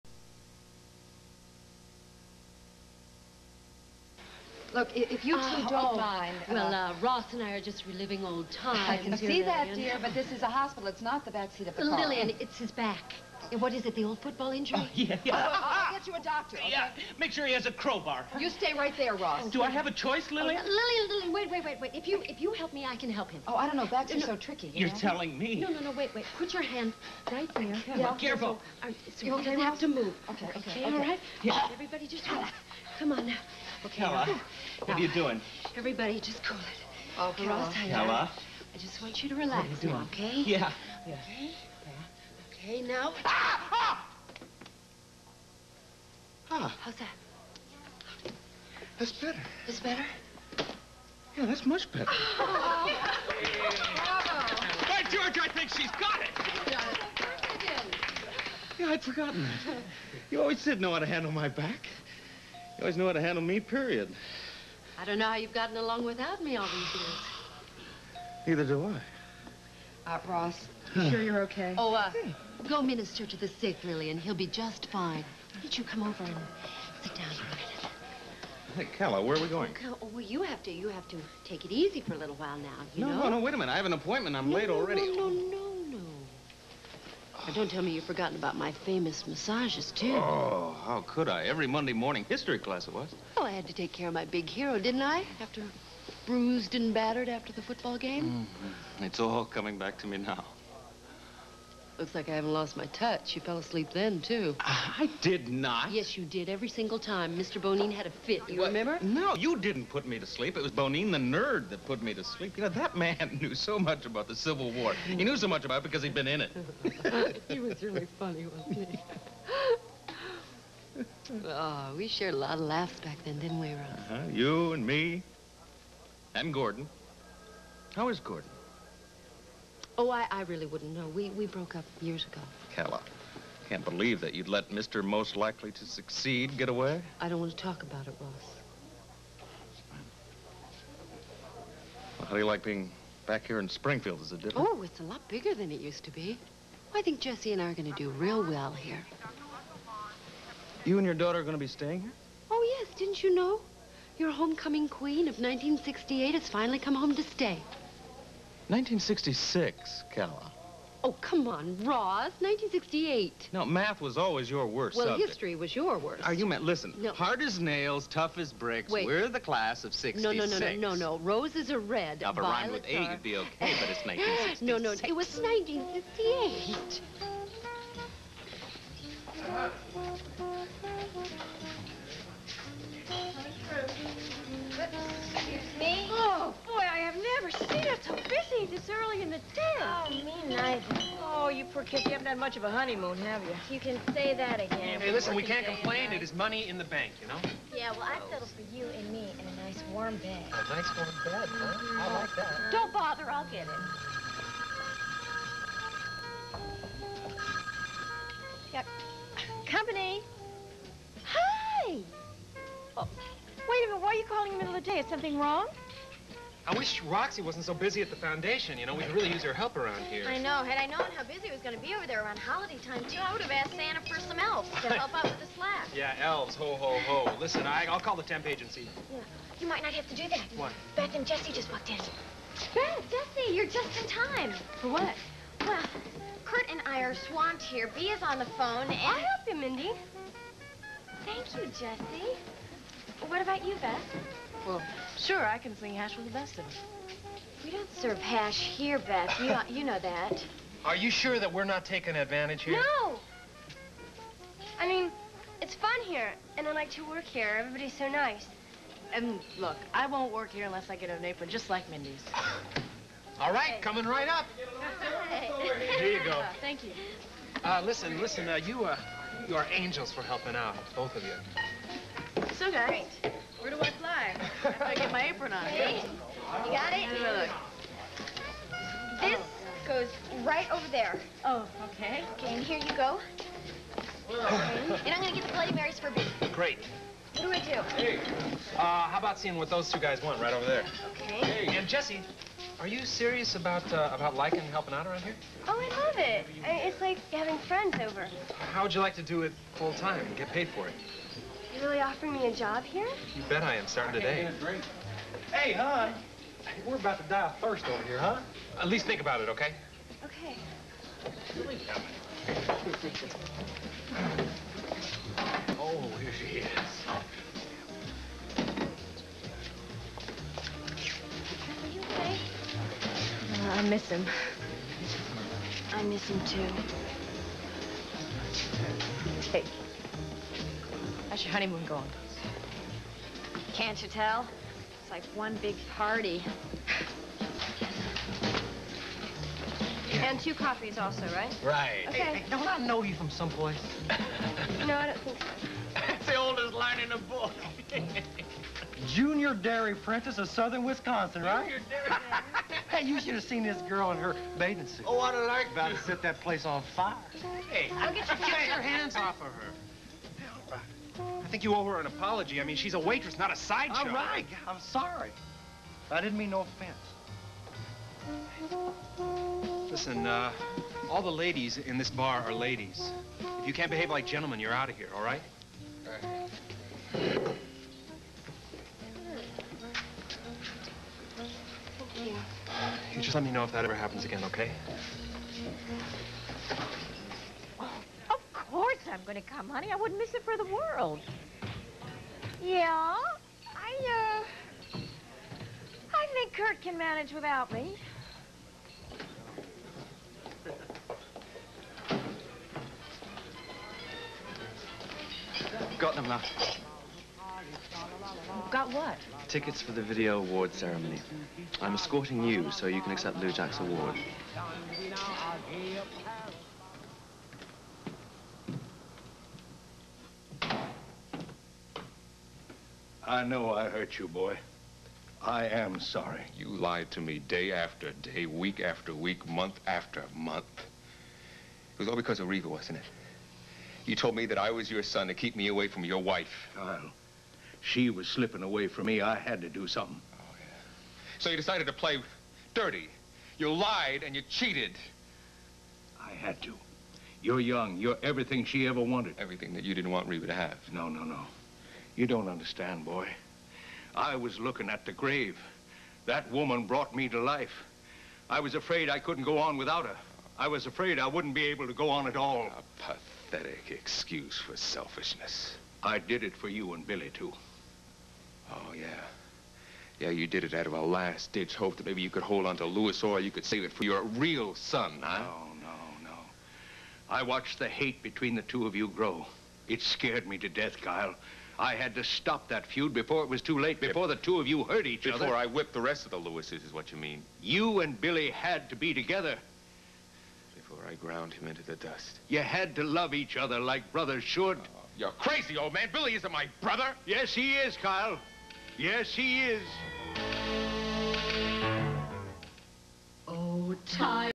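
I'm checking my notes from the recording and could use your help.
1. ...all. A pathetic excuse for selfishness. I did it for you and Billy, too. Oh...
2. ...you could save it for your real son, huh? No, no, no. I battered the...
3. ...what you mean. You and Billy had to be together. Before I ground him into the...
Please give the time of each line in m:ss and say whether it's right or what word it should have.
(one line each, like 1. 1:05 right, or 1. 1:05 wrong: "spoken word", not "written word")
1. 7:42 right
2. 7:53 wrong: "watched", not "battered"
3. 8:06 right.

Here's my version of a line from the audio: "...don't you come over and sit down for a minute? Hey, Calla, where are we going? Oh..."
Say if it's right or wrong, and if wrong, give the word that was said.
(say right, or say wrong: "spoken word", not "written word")
right.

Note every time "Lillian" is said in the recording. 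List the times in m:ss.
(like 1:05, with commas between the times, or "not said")
0:11, 1:13.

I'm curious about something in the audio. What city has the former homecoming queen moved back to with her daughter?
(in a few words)
Springfield.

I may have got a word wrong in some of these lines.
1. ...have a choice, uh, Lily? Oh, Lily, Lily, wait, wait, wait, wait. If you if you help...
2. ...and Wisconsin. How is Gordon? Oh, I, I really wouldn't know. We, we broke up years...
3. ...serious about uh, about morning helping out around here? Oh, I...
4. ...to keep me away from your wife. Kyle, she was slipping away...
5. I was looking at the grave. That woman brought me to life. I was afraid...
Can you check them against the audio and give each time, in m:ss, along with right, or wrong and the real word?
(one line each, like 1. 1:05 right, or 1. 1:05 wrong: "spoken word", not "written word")
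1. 0:19 right
2. 2:06 wrong: "Gordon", not "Wisconsin"
3. 4:53 wrong: "liking", not "morning"
4. 7:15 right
5. 7:34 right.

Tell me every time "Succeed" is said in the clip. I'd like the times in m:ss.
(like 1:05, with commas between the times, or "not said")
2:15.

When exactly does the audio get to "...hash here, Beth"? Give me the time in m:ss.
4:08.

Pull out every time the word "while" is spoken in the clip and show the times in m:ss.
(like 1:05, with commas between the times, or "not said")
1:22.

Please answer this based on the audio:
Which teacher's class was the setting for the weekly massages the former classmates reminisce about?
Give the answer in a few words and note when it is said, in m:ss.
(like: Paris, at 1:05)
Mr. Bonine, at 1:47.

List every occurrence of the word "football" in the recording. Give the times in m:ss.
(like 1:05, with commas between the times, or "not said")
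0:14, 1:37.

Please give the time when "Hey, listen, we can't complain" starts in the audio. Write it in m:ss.
3:15.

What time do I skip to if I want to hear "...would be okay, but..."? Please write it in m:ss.
2:53.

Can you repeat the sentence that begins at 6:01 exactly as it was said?
I think you owe her an apology.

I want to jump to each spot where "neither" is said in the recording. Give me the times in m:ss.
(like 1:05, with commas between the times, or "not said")
1:08, 3:10.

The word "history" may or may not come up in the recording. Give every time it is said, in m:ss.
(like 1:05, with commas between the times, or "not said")
1:32, 2:45.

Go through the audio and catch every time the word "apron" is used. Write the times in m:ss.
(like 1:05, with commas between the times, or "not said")
4:21, 4:35.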